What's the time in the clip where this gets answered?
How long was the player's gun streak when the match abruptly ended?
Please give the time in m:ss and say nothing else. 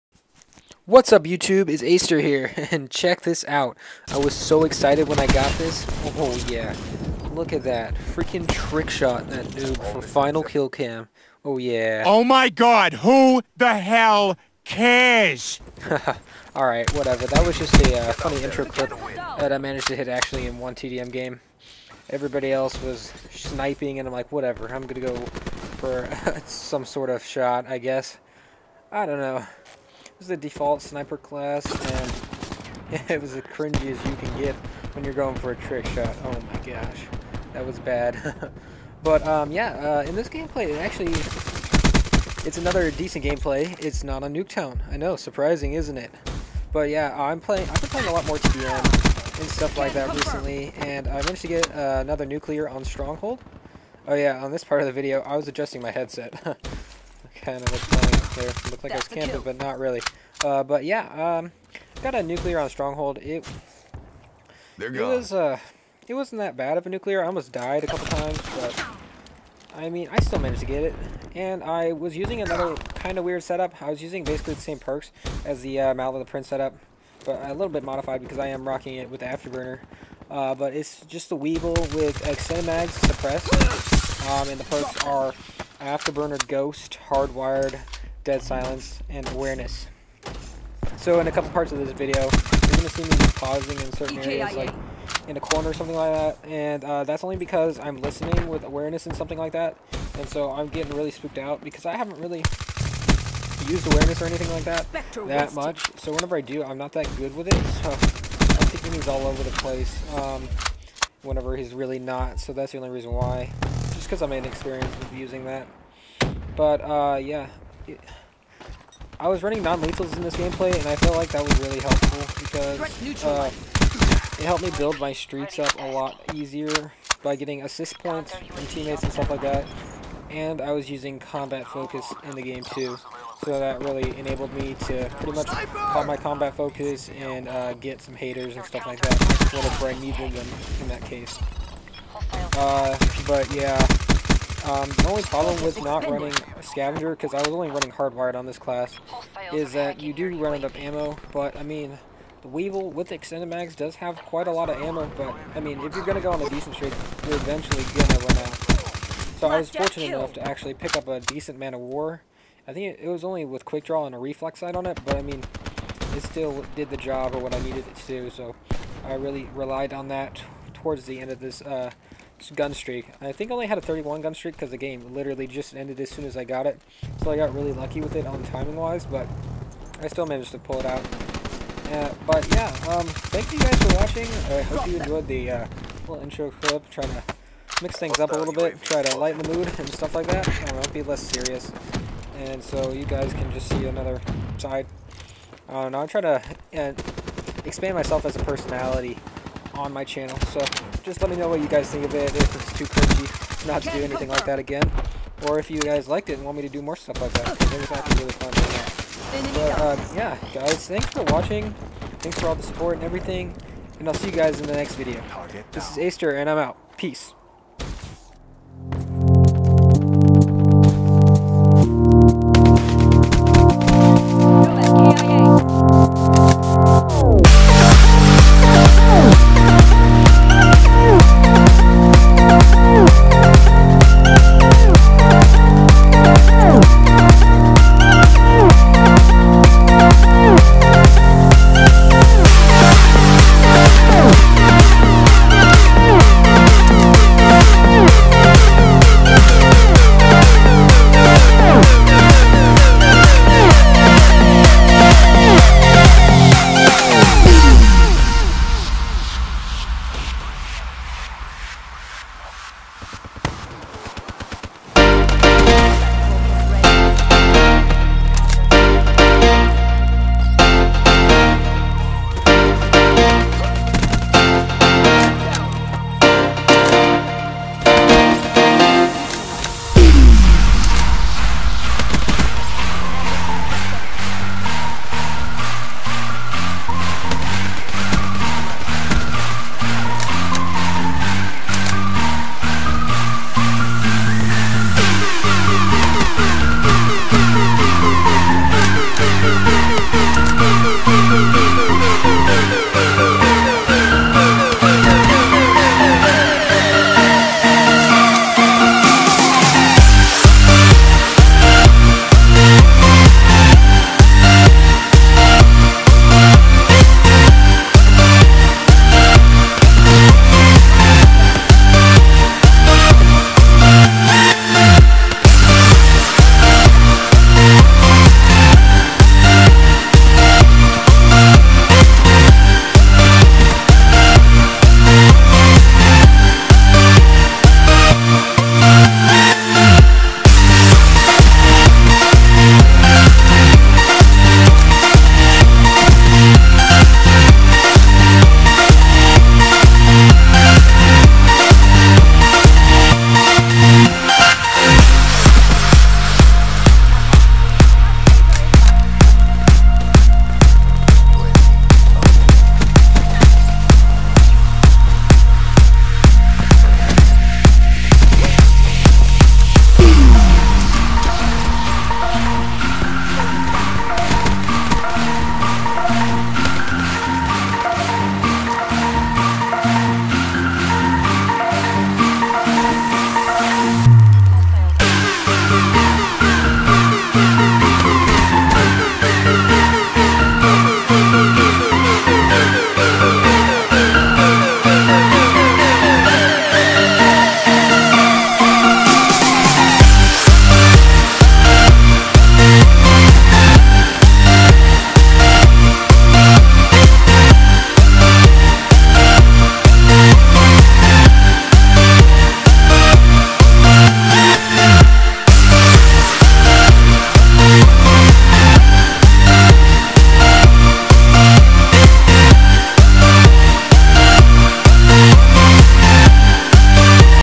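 2:53.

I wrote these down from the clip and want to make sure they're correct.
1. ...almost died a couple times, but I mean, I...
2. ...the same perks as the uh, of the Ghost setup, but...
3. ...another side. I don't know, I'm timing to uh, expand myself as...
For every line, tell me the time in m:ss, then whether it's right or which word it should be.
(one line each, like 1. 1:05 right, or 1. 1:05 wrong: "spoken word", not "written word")
1. 1:07 right
2. 1:14 wrong: "Prince", not "Ghost"
3. 3:13 wrong: "trying", not "timing".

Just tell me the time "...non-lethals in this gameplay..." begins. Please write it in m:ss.
1:59.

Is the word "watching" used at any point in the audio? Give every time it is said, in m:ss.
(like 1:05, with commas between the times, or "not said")
3:03, 3:31.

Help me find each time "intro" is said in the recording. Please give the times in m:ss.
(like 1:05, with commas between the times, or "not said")
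0:18, 3:06.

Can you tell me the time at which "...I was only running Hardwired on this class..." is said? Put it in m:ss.
2:27.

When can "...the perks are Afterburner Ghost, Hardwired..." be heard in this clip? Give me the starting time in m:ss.
1:24.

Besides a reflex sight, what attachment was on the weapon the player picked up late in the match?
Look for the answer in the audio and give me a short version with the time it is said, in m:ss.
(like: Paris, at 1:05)
Quick draw, at 2:43.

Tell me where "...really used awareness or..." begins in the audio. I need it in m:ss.
1:42.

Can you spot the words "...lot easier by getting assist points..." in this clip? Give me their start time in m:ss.
2:05.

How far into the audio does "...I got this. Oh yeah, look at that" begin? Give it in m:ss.
0:05.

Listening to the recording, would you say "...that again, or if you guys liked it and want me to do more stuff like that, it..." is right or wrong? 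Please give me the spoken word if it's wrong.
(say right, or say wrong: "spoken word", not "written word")
right.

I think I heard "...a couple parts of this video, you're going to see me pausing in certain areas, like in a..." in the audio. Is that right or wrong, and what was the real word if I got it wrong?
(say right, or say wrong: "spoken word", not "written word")
right.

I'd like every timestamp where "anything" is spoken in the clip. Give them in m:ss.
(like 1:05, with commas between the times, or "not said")
1:44, 3:24.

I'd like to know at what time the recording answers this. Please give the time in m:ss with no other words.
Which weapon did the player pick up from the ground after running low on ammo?
2:41.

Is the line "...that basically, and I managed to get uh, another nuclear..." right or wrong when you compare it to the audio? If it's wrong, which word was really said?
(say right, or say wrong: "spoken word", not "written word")
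wrong: "recently", not "basically".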